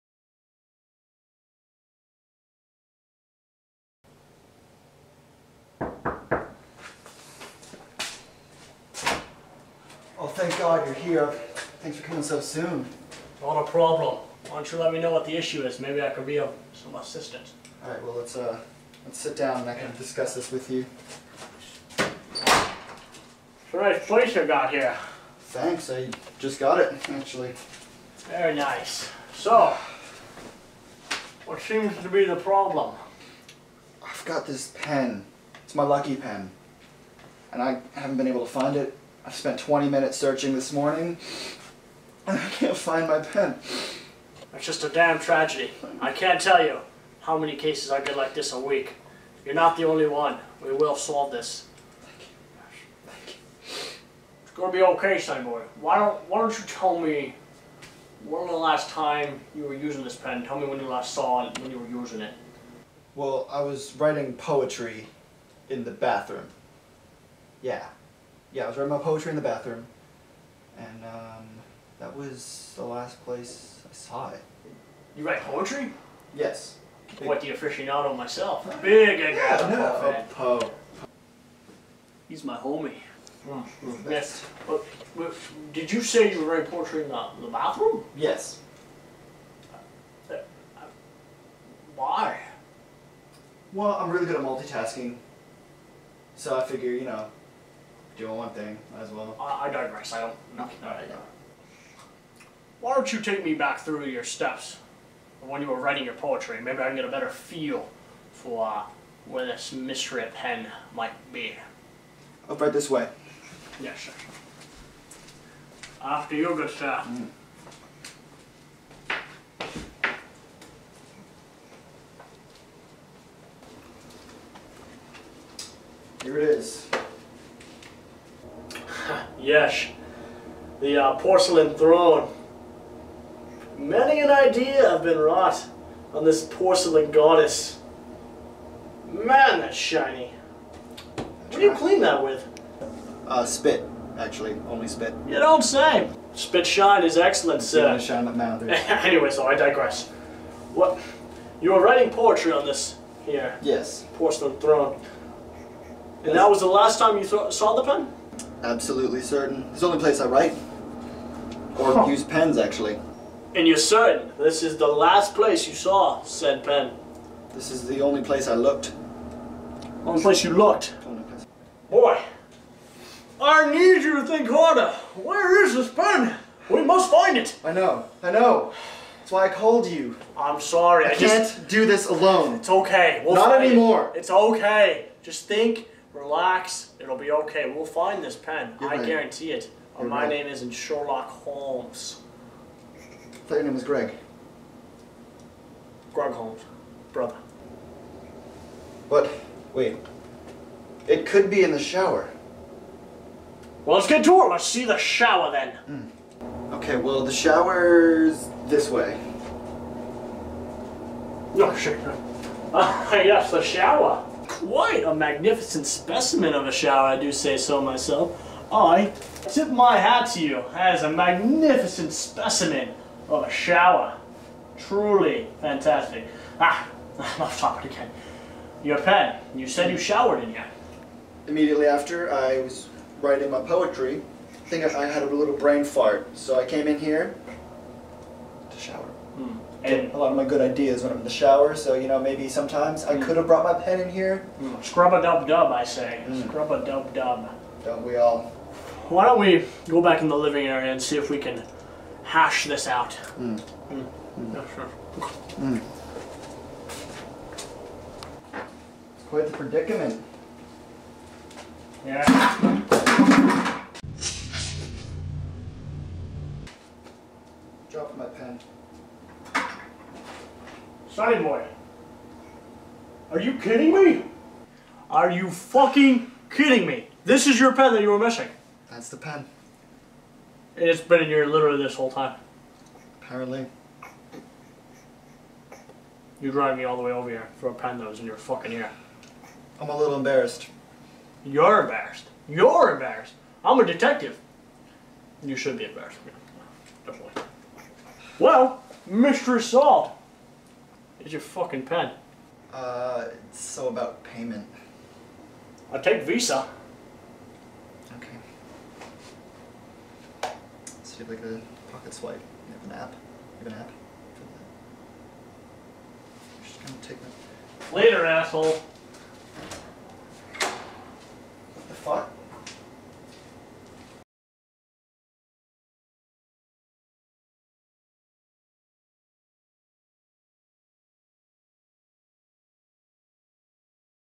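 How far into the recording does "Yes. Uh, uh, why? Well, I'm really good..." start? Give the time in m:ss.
1:28.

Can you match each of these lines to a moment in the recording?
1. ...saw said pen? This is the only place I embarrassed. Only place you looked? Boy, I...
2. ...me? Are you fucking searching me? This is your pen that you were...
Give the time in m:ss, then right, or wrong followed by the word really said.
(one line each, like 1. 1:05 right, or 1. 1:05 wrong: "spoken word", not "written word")
1. 2:45 wrong: "looked", not "embarrassed"
2. 4:33 wrong: "kidding", not "searching".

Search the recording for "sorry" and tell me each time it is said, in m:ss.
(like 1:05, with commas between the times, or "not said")
3:00.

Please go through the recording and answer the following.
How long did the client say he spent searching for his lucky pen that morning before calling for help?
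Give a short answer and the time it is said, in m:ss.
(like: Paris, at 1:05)
20 minutes, at 0:39.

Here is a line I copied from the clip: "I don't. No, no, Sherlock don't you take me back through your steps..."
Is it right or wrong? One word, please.
wrong.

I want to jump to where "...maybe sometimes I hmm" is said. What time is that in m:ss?
4:02.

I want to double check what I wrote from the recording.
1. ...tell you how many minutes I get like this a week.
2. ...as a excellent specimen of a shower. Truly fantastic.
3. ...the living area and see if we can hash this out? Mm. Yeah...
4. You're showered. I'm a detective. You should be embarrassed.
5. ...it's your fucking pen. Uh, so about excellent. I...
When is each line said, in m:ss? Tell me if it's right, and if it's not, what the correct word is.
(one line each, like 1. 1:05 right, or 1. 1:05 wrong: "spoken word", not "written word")
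1. 0:46 wrong: "cases", not "minutes"
2. 3:40 wrong: "magnificent", not "excellent"
3. 4:10 right
4. 4:52 wrong: "embarrassed", not "showered"
5. 5:01 wrong: "payment", not "excellent".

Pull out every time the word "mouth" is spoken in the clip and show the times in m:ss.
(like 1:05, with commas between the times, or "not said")
2:28.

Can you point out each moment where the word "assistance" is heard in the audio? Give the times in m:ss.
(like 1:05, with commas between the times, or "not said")
0:16.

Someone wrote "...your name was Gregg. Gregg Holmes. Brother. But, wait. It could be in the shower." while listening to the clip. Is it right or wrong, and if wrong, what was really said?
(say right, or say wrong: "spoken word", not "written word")
right.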